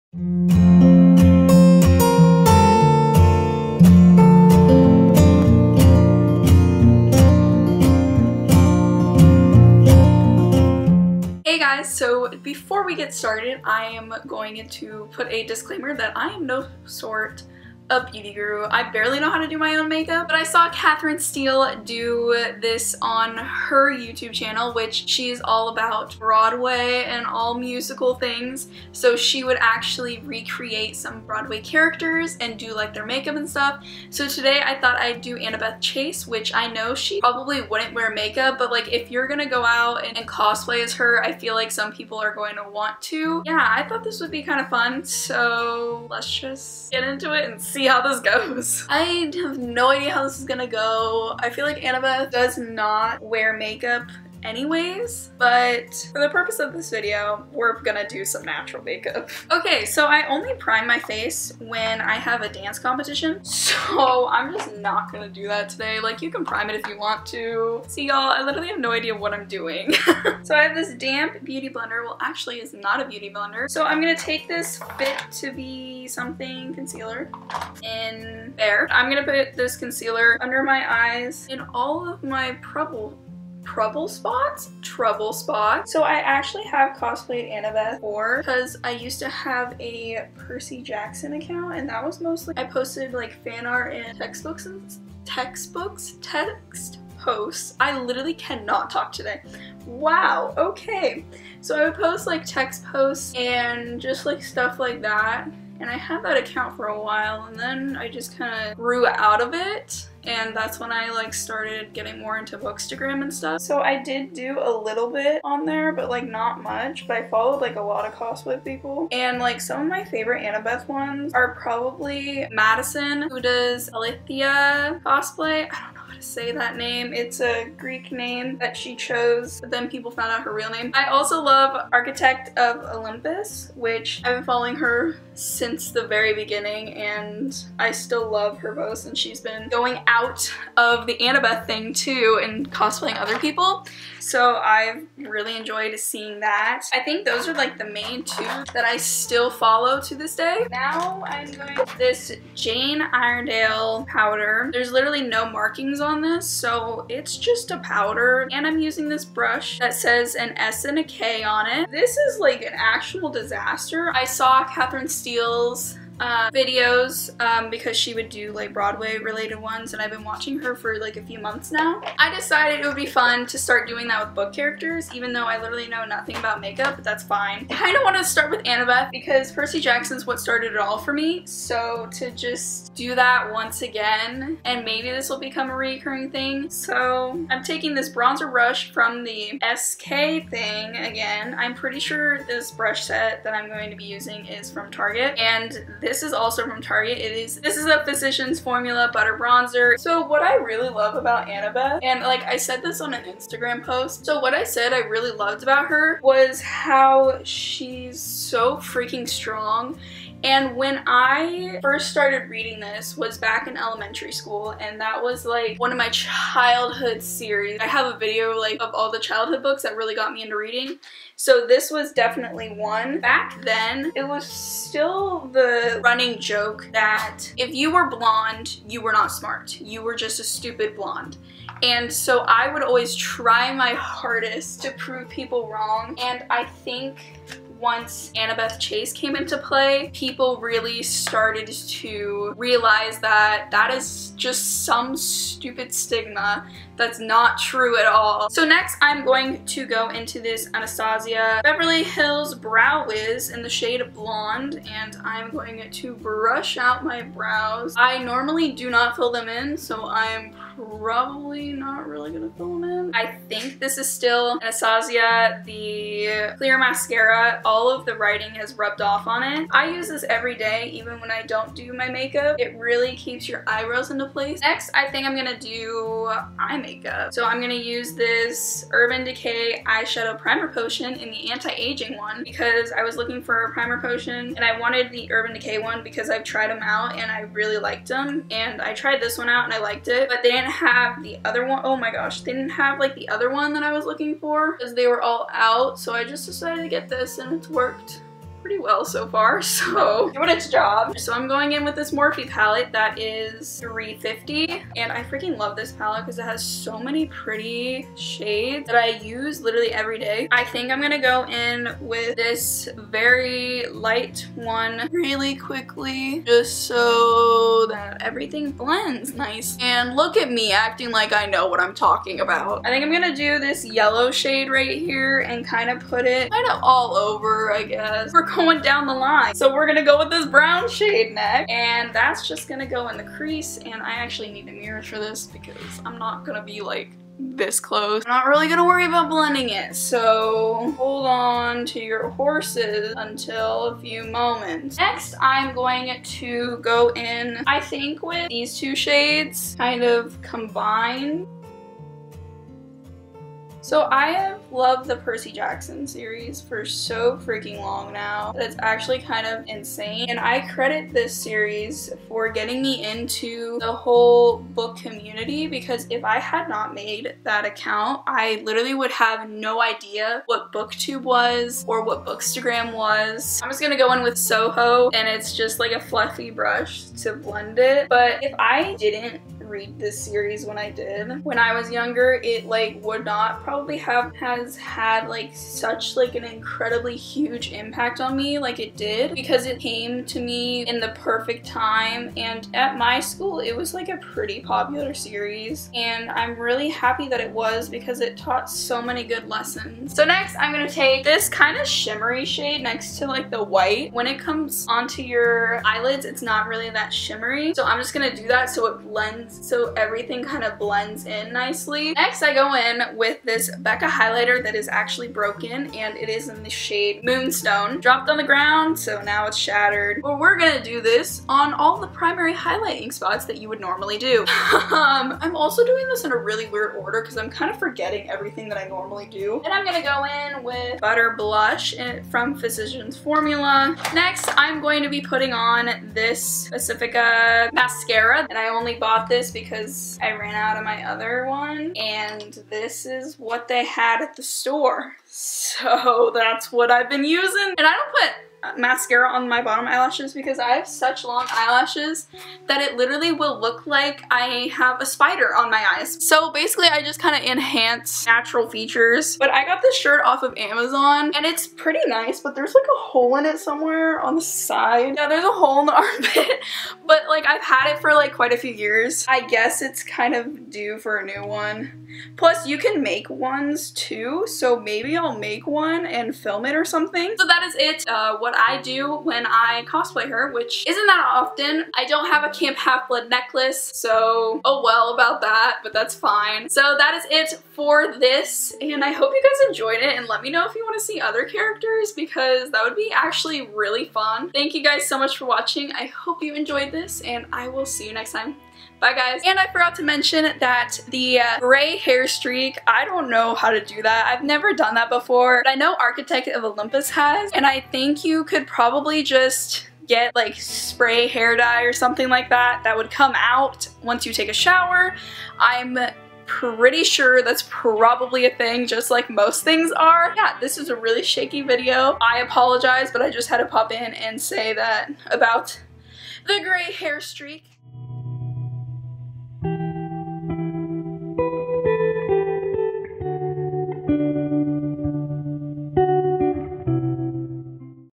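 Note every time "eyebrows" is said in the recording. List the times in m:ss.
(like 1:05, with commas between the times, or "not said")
4:33.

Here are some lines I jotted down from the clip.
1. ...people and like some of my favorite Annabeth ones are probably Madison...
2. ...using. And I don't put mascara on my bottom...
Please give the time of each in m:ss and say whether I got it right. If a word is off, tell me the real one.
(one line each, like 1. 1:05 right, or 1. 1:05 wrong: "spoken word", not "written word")
1. 1:58 right
2. 7:27 right.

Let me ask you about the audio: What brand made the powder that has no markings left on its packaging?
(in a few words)
Jane Iredale.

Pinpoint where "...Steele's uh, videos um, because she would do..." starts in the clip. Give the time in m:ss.
2:45.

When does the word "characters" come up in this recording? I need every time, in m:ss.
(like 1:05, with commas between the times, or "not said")
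0:31, 2:54, 8:11.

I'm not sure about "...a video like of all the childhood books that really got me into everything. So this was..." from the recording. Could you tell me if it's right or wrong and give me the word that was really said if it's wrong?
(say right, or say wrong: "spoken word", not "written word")
wrong: "reading", not "everything".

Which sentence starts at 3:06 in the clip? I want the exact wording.
So I'm taking this bronzer brush from the SK thing again.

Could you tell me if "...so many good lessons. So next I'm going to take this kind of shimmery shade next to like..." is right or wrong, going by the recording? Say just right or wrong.
right.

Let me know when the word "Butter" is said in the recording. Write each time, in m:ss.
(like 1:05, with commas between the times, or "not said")
3:19, 7:10.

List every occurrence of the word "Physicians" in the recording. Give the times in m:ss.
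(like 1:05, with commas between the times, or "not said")
3:18, 7:12.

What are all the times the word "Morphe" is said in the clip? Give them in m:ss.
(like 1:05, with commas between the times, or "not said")
5:02.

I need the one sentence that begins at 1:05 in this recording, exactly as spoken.
Like, you can prime it if you want to.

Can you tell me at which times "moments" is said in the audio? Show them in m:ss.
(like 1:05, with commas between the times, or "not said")
5:44.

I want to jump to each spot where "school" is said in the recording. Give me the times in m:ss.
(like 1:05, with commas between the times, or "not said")
3:34, 6:33.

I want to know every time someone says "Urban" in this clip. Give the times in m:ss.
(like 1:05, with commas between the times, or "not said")
4:38, 4:45.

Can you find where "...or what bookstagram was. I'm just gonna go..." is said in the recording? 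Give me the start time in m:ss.
6:11.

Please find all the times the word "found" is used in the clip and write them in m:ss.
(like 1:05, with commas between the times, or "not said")
2:10.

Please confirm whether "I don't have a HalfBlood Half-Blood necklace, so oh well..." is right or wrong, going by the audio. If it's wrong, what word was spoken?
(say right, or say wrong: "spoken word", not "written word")
wrong: "Camp", not "HalfBlood".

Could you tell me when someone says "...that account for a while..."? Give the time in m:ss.
1:46.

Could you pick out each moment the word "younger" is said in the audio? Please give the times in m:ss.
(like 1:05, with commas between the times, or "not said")
6:21.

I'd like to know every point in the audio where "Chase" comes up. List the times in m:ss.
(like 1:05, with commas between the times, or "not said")
0:35, 3:58.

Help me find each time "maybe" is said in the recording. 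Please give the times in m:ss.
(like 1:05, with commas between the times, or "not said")
3:04, 7:54.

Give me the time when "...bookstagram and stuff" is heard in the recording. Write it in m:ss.
1:52.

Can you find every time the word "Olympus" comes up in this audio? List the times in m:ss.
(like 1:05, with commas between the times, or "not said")
2:12, 8:26.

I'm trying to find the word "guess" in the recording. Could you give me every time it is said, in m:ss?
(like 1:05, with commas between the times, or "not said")
5:27, 7:49.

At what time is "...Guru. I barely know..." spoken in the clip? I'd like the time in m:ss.
0:18.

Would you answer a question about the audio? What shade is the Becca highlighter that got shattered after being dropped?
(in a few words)
Moonstone.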